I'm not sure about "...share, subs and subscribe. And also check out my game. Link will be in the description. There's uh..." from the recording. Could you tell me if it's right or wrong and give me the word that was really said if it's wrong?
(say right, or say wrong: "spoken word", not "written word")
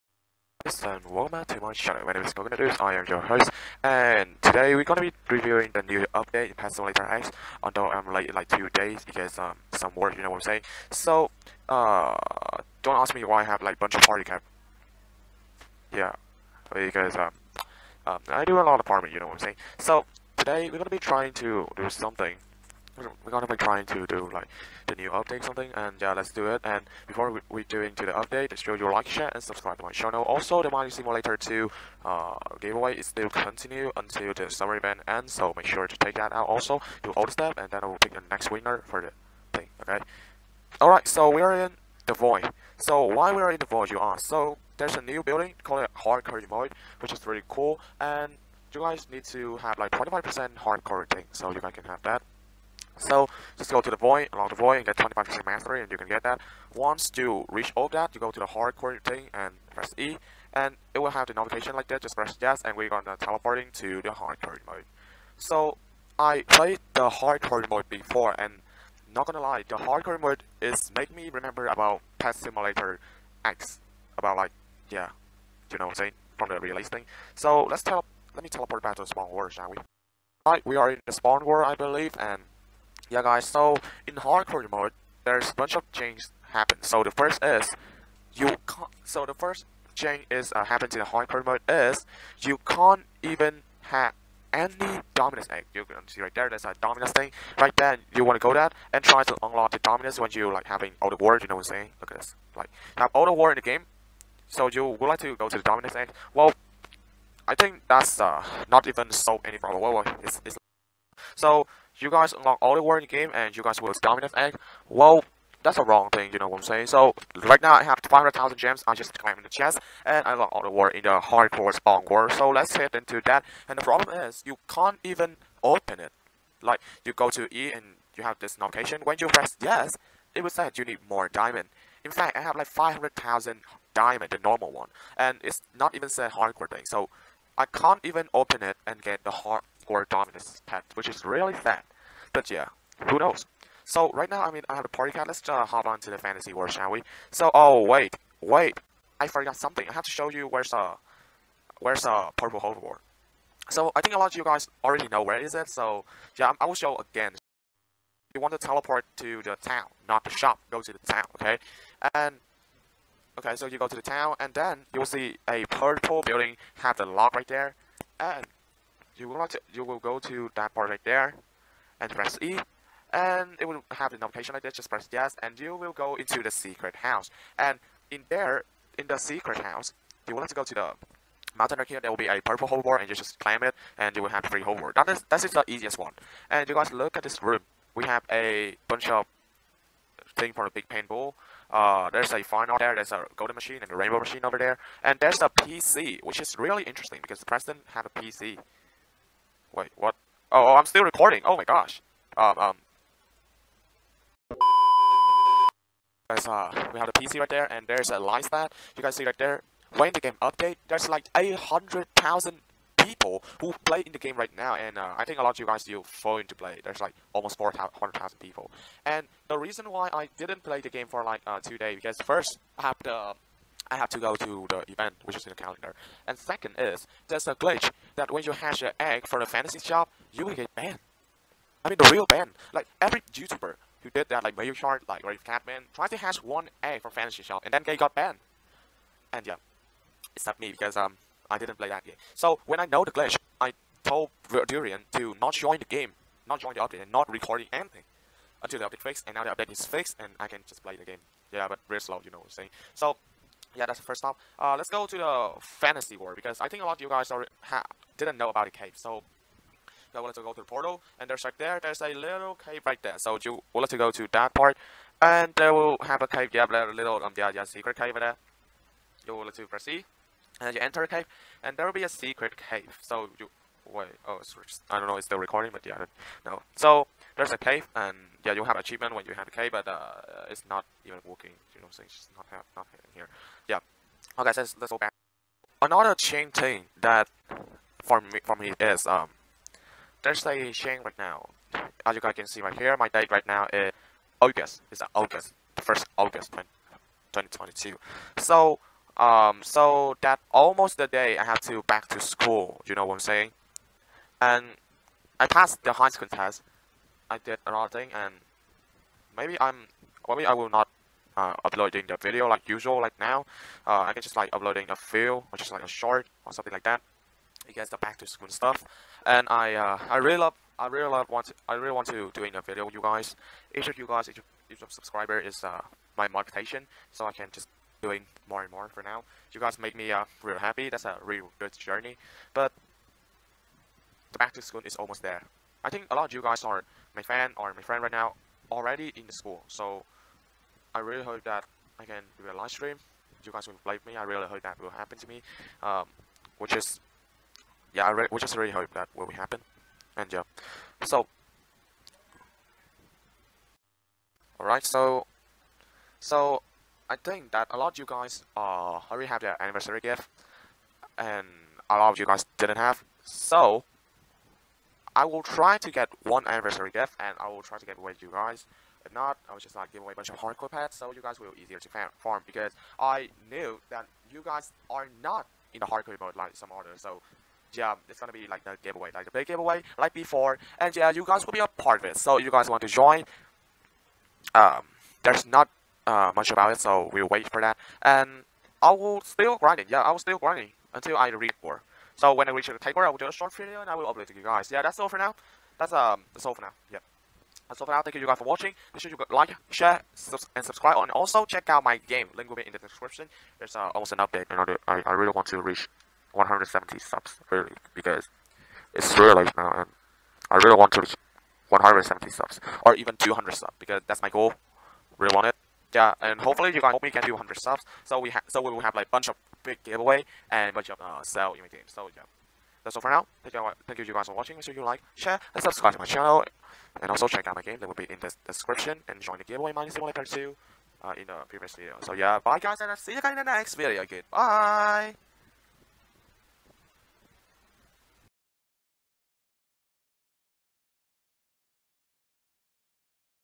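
right.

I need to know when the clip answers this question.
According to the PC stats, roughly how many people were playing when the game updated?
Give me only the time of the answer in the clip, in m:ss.
3:31.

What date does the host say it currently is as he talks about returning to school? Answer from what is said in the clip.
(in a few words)
August 1, 2022.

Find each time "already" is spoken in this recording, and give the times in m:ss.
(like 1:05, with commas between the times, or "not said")
2:34, 5:38, 5:59.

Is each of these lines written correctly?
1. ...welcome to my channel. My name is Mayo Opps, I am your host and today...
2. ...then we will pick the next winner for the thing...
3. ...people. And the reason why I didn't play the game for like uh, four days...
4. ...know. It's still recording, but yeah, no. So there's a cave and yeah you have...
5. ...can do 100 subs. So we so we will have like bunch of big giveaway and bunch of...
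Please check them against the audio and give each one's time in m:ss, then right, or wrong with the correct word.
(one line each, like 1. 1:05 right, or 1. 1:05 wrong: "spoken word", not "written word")
1. 0:01 wrong: "Coconut", not "Mayo"
2. 0:37 right
3. 3:38 wrong: "two", not "four"
4. 4:35 right
5. 6:57 right.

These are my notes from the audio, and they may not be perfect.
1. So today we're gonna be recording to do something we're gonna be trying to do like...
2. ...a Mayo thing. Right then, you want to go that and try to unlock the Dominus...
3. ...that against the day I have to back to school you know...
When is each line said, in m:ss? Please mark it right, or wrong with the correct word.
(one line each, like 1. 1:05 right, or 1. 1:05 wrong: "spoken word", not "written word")
1. 0:19 wrong: "trying", not "recording"
2. 1:36 wrong: "Dominus", not "Mayo"
3. 5:00 wrong: "almost", not "against".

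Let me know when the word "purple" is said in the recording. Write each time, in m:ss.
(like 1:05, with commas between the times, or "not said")
2:32, 2:45, 3:02.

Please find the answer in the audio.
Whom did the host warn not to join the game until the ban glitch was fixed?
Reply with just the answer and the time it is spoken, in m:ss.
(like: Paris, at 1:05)
Durian, at 4:04.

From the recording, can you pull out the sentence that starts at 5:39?
So I really hope that I can do a live stream.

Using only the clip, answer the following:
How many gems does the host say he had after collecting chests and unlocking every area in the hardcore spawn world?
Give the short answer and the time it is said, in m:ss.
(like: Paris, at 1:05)
500,000, at 1:58.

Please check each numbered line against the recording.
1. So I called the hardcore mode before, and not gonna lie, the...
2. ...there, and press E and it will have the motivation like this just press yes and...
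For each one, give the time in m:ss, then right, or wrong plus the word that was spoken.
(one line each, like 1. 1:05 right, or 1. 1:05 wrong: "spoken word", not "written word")
1. 1:05 wrong: "played", not "called"
2. 2:51 wrong: "notification", not "motivation".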